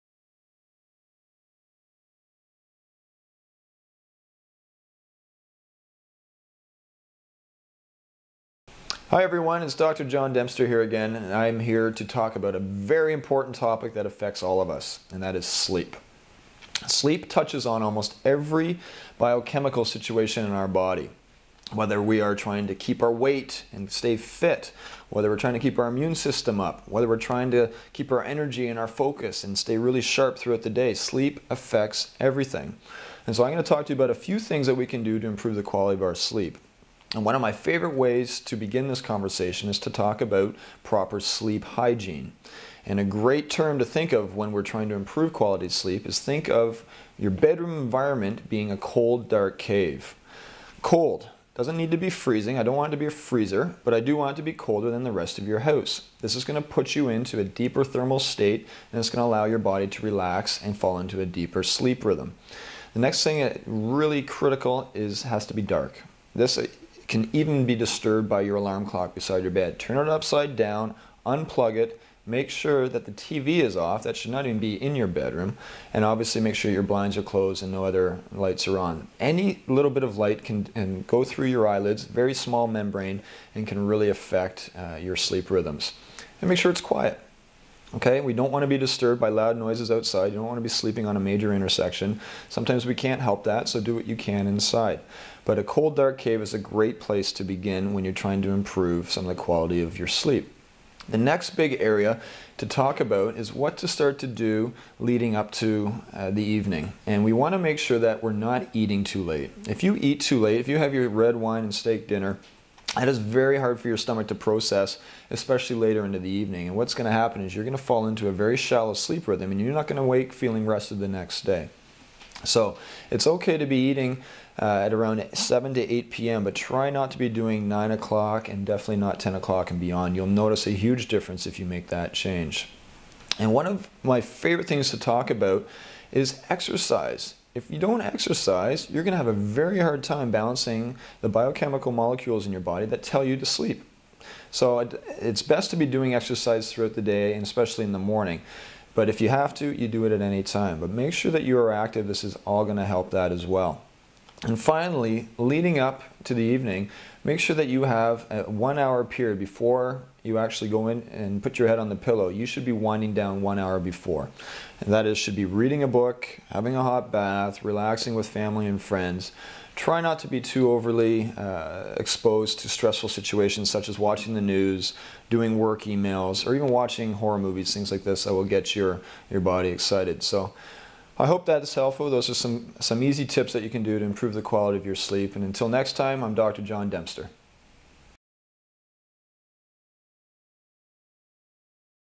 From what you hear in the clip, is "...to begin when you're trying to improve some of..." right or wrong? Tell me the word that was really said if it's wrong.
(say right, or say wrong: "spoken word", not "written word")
right.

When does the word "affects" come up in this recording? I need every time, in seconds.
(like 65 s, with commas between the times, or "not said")
14 s, 31 s, 84 s.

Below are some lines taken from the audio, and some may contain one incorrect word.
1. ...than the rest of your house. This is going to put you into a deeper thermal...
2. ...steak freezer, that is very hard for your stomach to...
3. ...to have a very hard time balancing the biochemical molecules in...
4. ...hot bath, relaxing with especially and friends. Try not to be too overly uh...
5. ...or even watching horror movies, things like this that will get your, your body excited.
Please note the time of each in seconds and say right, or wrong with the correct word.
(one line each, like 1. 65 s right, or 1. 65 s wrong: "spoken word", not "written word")
1. 54 s right
2. 111 s wrong: "dinner", not "freezer"
3. 139 s right
4. 166 s wrong: "family", not "especially"
5. 176 s right.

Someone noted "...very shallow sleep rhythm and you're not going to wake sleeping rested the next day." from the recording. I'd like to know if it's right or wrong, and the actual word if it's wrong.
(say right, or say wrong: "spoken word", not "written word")
wrong: "feeling", not "sleeping".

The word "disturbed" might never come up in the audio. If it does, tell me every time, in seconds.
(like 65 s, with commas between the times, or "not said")
67 s, 88 s.